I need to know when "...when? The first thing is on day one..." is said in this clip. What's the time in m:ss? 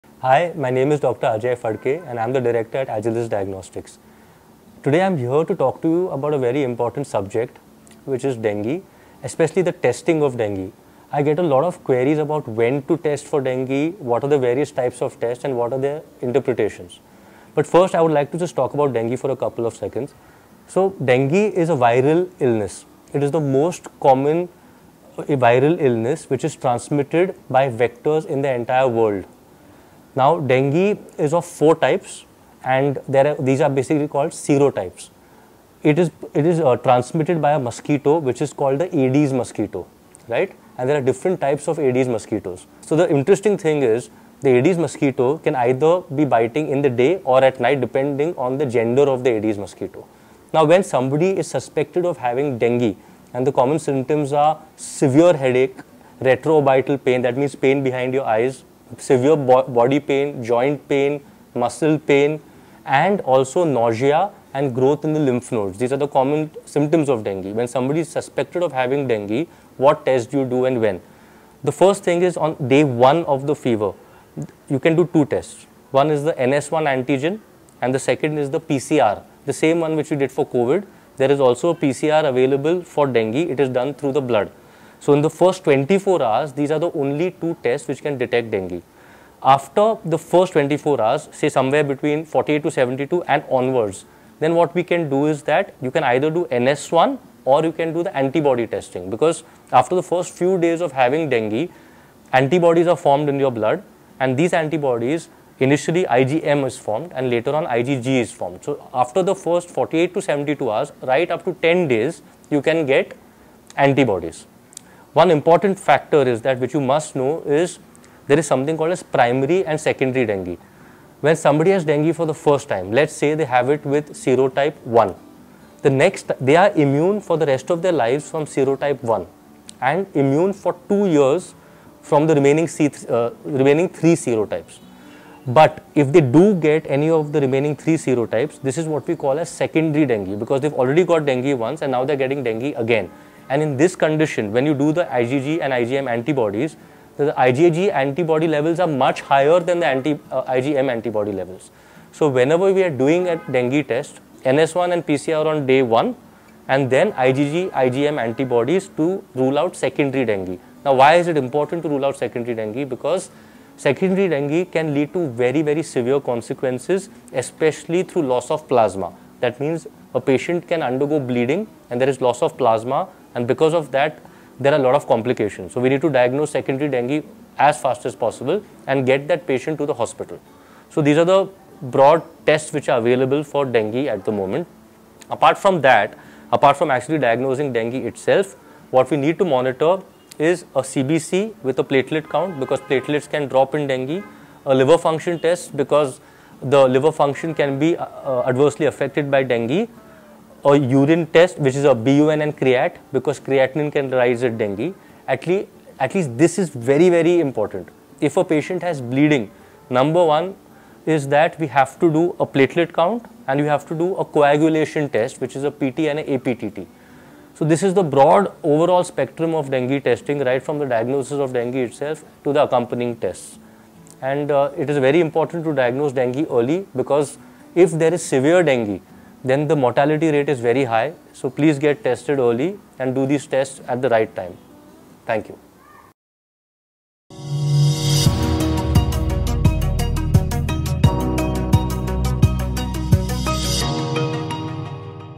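1:10.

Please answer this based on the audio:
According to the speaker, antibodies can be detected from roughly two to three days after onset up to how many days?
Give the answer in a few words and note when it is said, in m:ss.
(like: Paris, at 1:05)
10 days, at 1:51.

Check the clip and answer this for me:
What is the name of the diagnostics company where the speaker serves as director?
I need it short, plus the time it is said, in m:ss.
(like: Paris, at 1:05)
Agilus Diagnostics, at 0:02.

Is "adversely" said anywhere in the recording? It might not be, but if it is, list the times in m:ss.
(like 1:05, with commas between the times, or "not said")
3:18.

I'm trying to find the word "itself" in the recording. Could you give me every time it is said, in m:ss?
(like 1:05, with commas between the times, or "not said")
3:07, 3:41.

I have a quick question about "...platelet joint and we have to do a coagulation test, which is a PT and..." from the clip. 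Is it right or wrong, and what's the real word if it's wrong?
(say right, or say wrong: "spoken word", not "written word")
wrong: "count", not "joint".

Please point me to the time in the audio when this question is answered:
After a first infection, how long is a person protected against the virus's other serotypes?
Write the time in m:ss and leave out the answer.
2:10.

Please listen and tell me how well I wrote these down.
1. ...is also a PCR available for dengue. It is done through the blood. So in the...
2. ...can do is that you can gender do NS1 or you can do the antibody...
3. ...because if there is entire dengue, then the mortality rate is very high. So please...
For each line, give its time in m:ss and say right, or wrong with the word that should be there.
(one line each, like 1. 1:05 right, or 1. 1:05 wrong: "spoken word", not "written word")
1. 1:21 right
2. 1:34 wrong: "either", not "gender"
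3. 3:46 wrong: "severe", not "entire".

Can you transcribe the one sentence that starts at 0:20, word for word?
So dengue is a viral illness.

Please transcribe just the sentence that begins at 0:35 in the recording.
It is it is uh, transmitted by a mosquito, which is called the Aedes mosquito, right?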